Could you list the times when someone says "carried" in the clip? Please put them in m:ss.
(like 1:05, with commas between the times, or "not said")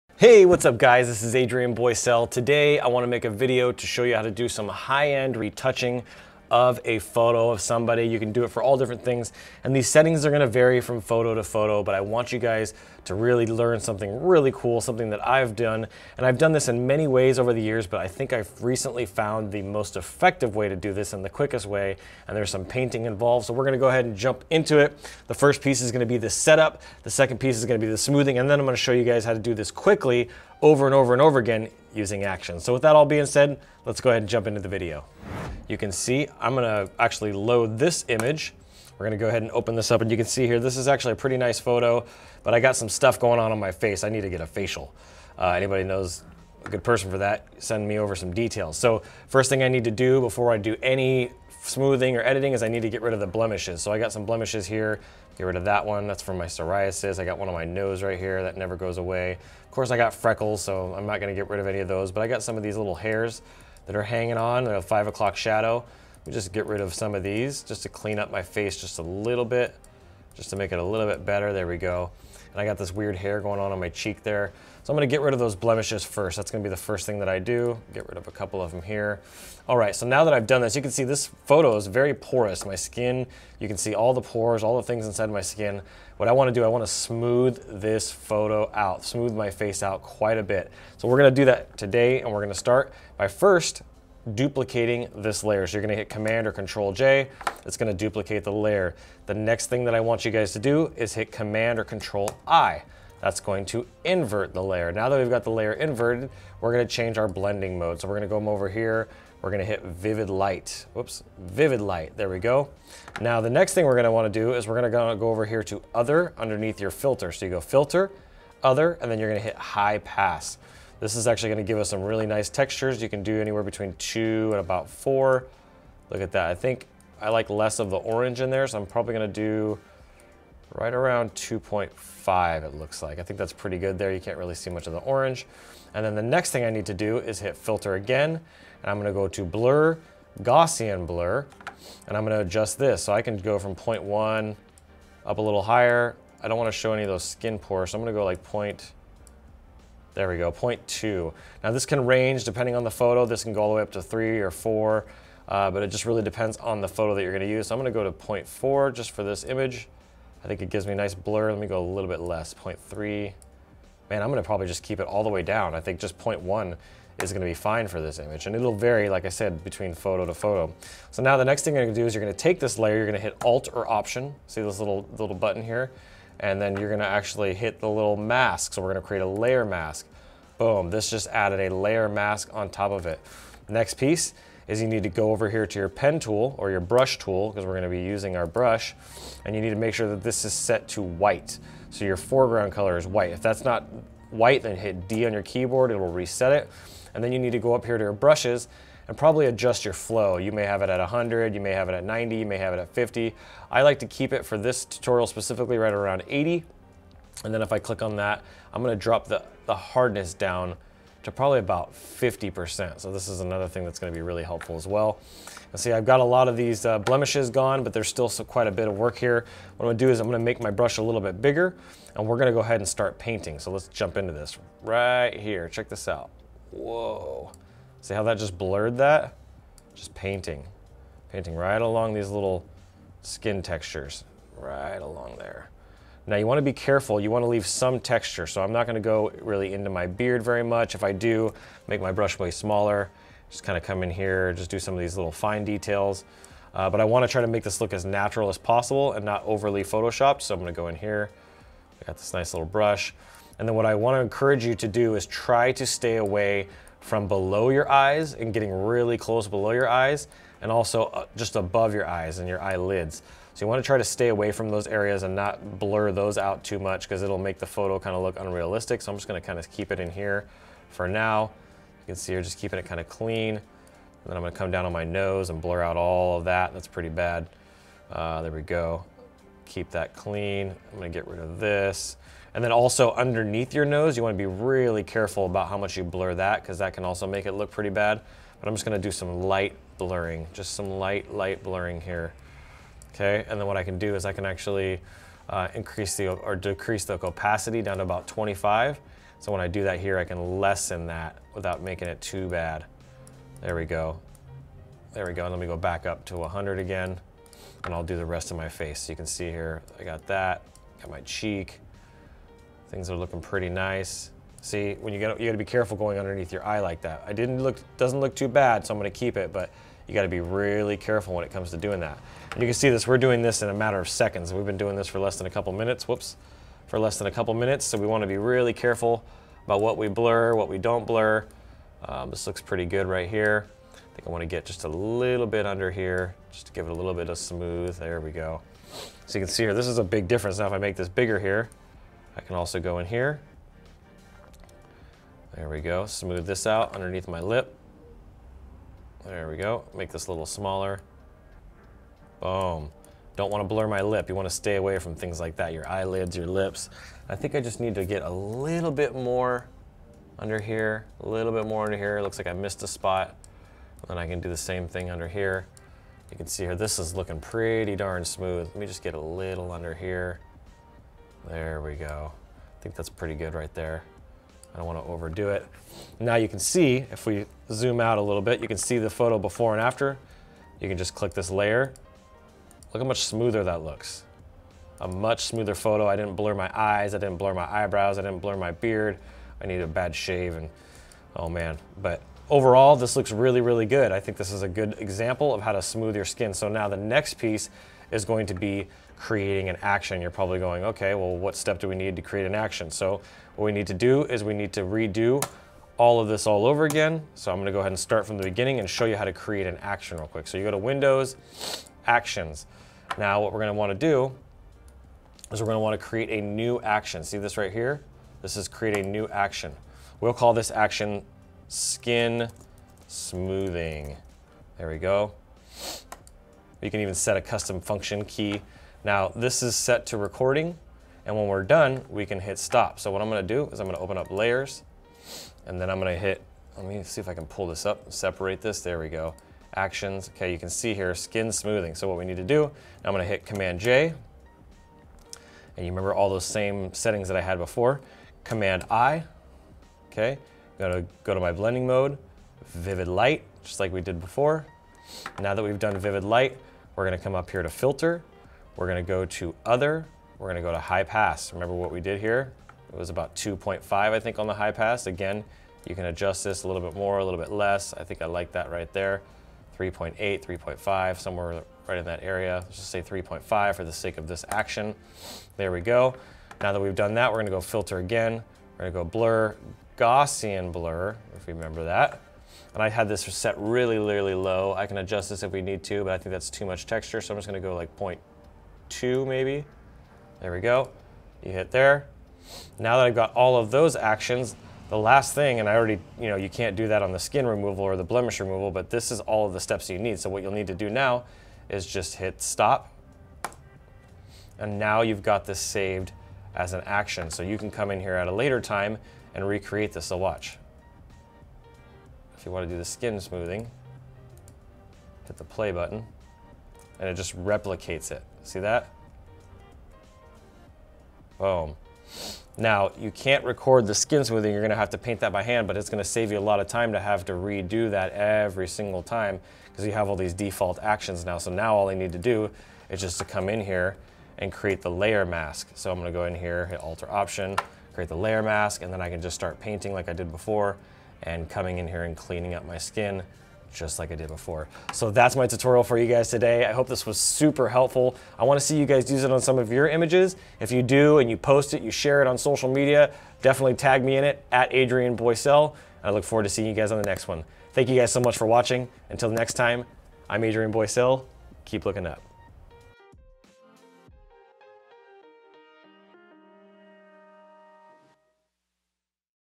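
not said.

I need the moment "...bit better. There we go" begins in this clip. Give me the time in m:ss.
1:11.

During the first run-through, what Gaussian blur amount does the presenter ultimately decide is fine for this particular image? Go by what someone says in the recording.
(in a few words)
0.1.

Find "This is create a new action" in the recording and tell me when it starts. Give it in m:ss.
6:58.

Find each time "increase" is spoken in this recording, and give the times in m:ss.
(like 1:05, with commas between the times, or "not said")
4:55.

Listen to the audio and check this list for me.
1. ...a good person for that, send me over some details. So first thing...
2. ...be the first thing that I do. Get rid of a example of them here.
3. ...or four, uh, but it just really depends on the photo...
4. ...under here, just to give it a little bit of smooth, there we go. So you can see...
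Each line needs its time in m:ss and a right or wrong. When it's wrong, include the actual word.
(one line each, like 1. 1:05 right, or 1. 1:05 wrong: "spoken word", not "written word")
1. 0:46 right
2. 1:16 wrong: "couple", not "example"
3. 2:34 right
4. 5:35 right.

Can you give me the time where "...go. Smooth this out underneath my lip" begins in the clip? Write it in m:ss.
5:45.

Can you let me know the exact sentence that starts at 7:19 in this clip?
Actions, okay, you can see here, skin smoothing.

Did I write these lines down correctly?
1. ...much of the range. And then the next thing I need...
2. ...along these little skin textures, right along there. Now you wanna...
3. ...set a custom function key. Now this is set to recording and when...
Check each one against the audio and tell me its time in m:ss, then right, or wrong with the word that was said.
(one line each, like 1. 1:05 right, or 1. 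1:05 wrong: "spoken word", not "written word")
1. 2:14 wrong: "orange", not "range"
2. 3:51 right
3. 7:07 right.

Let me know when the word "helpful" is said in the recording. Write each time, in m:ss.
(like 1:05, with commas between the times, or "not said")
3:34, 9:07.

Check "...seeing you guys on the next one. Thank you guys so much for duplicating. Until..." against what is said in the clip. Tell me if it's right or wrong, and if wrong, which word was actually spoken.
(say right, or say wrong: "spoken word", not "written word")
wrong: "watching", not "duplicating".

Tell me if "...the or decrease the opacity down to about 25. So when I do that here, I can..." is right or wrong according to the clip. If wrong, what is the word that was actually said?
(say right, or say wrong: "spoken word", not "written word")
right.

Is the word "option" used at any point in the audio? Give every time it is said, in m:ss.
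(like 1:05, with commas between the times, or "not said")
2:53, 8:57.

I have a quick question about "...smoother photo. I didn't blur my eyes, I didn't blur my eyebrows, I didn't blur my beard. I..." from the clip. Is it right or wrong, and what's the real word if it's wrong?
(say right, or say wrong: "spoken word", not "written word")
right.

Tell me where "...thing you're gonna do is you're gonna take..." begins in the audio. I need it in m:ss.
2:51.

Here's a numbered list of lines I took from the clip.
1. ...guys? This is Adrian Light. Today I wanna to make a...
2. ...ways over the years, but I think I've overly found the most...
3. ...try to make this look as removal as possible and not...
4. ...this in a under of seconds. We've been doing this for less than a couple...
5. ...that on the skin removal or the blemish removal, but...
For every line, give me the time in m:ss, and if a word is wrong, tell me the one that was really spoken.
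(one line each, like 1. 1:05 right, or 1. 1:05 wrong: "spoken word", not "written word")
1. 0:00 wrong: "Boysel", not "Light"
2. 0:17 wrong: "recently", not "overly"
3. 4:07 wrong: "natural", not "removal"
4. 5:23 wrong: "matter", not "under"
5. 8:16 right.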